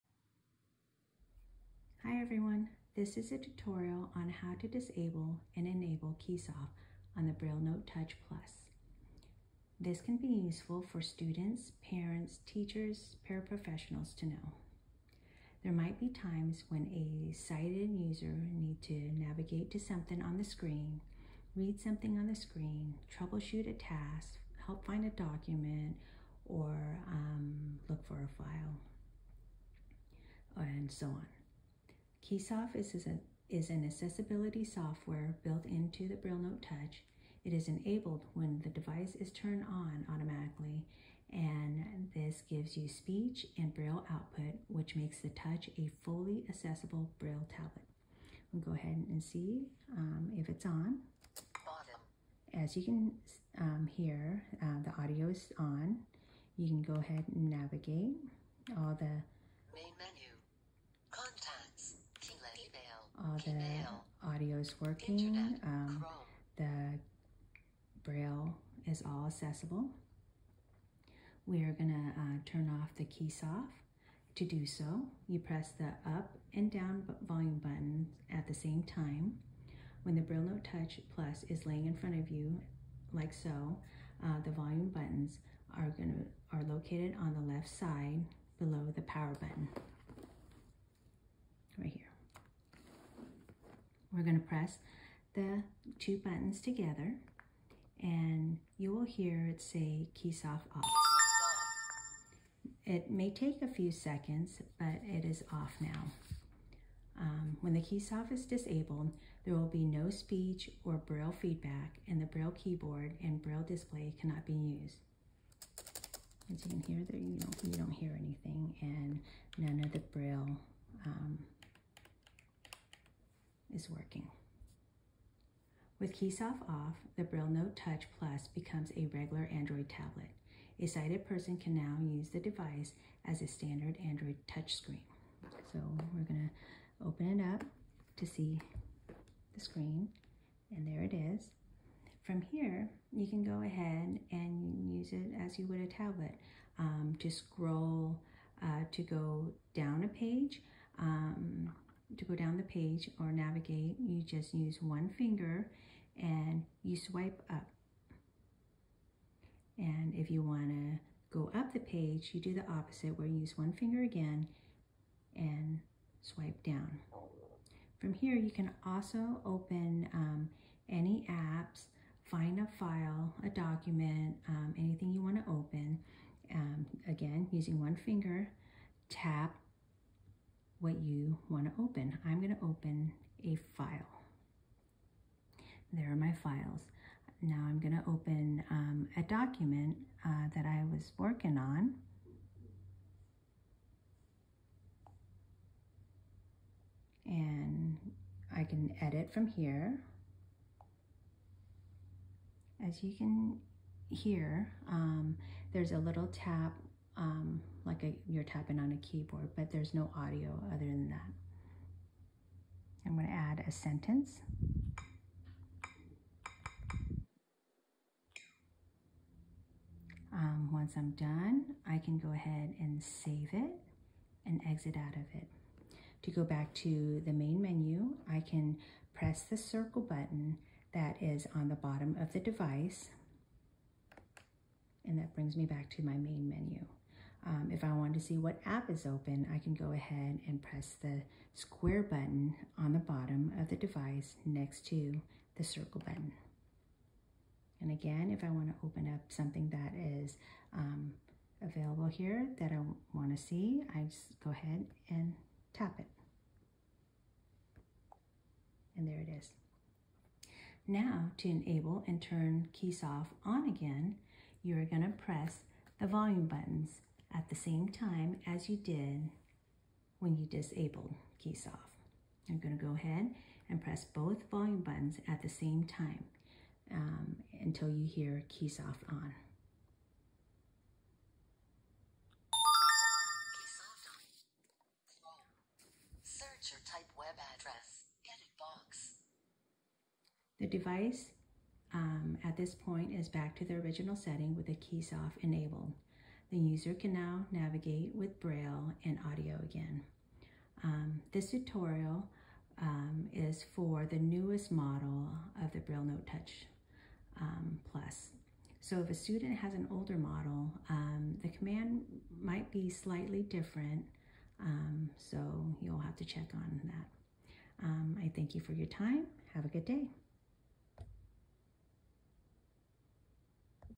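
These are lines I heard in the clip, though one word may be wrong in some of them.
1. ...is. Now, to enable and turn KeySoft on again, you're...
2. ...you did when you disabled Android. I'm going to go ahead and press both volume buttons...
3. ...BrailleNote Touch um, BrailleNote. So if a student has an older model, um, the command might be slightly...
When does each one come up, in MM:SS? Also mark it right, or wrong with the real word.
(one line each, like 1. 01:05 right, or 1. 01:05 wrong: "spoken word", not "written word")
1. 04:19 right
2. 04:28 wrong: "KeySoft", not "Android"
3. 05:05 wrong: "Plus", not "BrailleNote".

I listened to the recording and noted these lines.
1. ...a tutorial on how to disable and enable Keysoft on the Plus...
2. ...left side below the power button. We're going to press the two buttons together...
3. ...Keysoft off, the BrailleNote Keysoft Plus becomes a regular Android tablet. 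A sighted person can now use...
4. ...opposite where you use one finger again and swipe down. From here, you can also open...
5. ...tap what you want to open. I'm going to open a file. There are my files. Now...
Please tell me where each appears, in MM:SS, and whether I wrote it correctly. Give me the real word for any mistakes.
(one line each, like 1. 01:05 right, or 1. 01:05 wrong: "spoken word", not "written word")
1. 00:03 wrong: "BrailleNote", not "Plus"
2. 01:27 right
3. 02:06 wrong: "Touch", not "Keysoft"
4. 02:42 right
5. 02:59 right.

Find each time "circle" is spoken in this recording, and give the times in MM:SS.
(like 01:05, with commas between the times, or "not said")
03:49, 04:05.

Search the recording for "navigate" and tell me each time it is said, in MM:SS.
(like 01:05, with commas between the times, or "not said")
00:19, 00:57, 02:33, 04:57.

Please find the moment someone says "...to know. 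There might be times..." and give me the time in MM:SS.
00:14.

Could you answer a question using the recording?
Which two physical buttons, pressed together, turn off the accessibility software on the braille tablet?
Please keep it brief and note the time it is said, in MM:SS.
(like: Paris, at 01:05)
Up and down volume buttons, at 01:16.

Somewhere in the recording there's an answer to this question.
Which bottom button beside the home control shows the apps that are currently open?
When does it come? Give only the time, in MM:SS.
04:01.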